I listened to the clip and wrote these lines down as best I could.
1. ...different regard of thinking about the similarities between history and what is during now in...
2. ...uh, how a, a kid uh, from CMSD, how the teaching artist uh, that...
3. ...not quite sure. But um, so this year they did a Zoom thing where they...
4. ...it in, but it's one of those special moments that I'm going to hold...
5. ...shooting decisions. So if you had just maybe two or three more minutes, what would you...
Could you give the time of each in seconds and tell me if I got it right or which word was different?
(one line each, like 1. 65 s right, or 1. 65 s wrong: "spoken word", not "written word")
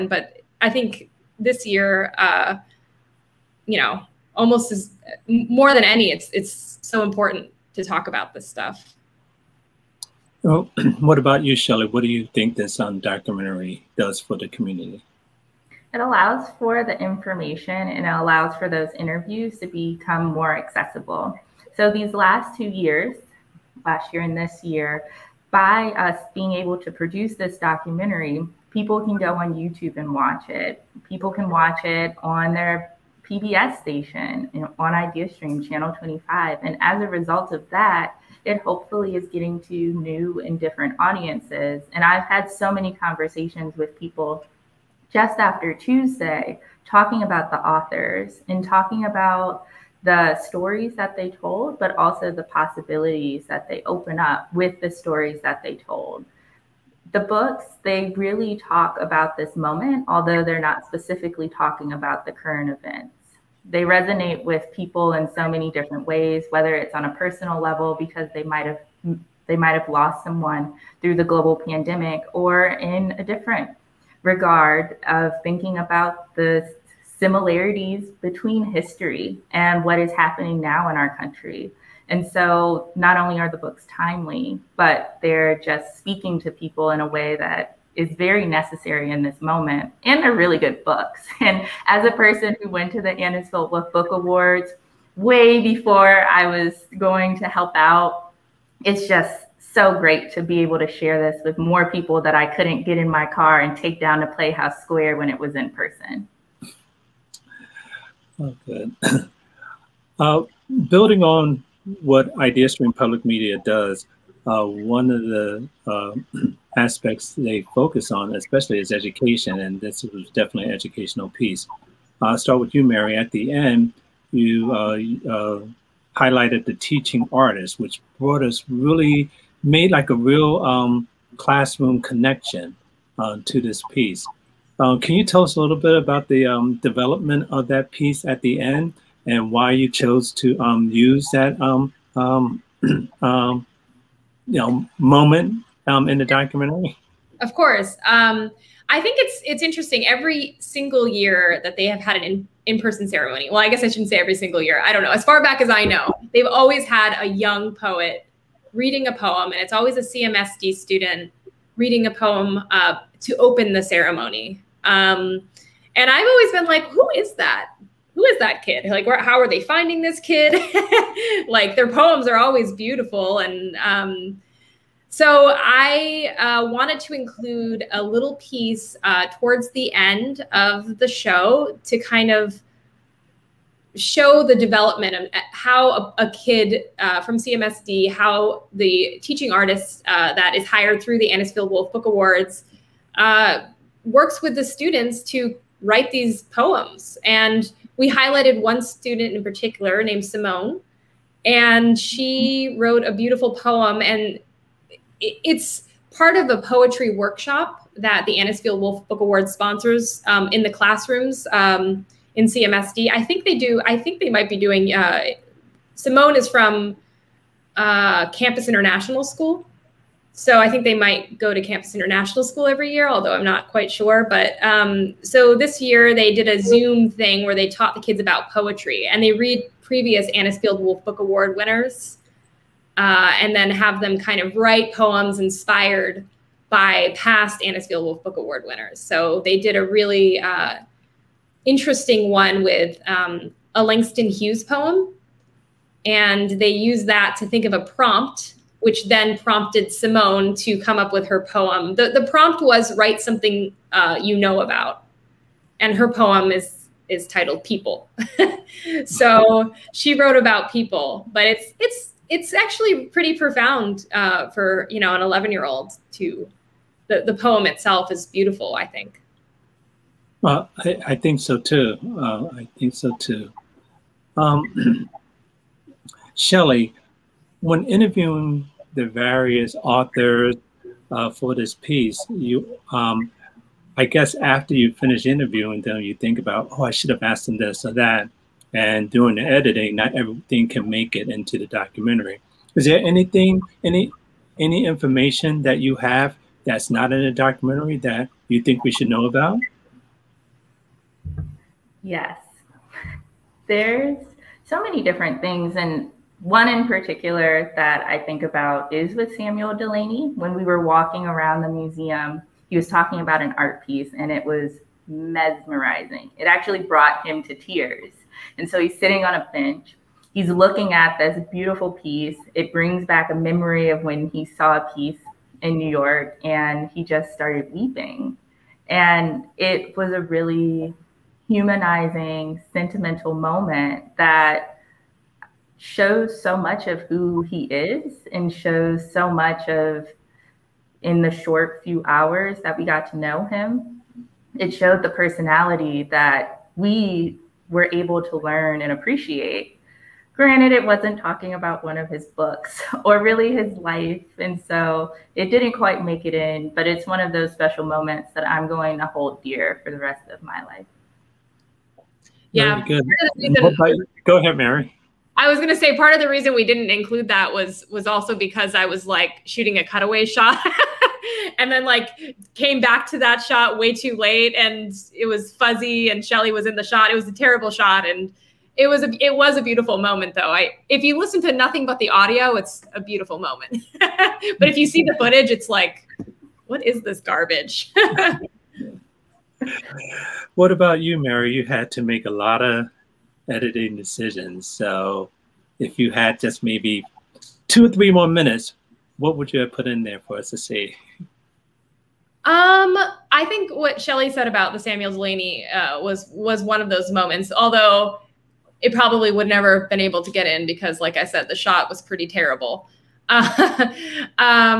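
1. 73 s wrong: "happening", not "during"
2. 185 s right
3. 223 s right
4. 356 s right
5. 393 s wrong: "editing", not "shooting".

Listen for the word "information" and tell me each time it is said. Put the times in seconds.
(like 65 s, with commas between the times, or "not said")
17 s, 294 s.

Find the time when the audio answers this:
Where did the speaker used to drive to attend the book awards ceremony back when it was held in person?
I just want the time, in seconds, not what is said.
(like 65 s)
104 s.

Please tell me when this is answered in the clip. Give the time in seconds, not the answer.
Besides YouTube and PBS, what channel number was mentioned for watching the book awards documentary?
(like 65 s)
35 s.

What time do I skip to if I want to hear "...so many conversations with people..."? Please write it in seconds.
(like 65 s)
42 s.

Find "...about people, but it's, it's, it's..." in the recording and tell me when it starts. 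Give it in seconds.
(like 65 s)
260 s.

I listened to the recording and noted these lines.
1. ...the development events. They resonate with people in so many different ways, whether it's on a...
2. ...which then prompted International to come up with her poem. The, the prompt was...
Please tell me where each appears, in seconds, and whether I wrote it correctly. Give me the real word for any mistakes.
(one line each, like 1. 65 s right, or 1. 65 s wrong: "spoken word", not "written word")
1. 62 s wrong: "current", not "development"
2. 248 s wrong: "Simone", not "International".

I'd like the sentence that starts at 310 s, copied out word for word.
When we were walking around the museum, he was talking about an art piece and it was mesmerizing.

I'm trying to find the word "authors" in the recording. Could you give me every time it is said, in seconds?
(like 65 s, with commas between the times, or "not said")
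47 s, 279 s.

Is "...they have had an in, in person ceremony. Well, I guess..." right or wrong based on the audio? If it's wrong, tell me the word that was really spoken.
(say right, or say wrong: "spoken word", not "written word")
right.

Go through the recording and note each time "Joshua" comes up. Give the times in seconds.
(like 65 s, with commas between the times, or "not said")
not said.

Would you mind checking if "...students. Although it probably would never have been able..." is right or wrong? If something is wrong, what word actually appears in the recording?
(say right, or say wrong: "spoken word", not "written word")
wrong: "moments", not "students".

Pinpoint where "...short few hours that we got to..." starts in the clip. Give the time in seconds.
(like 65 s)
341 s.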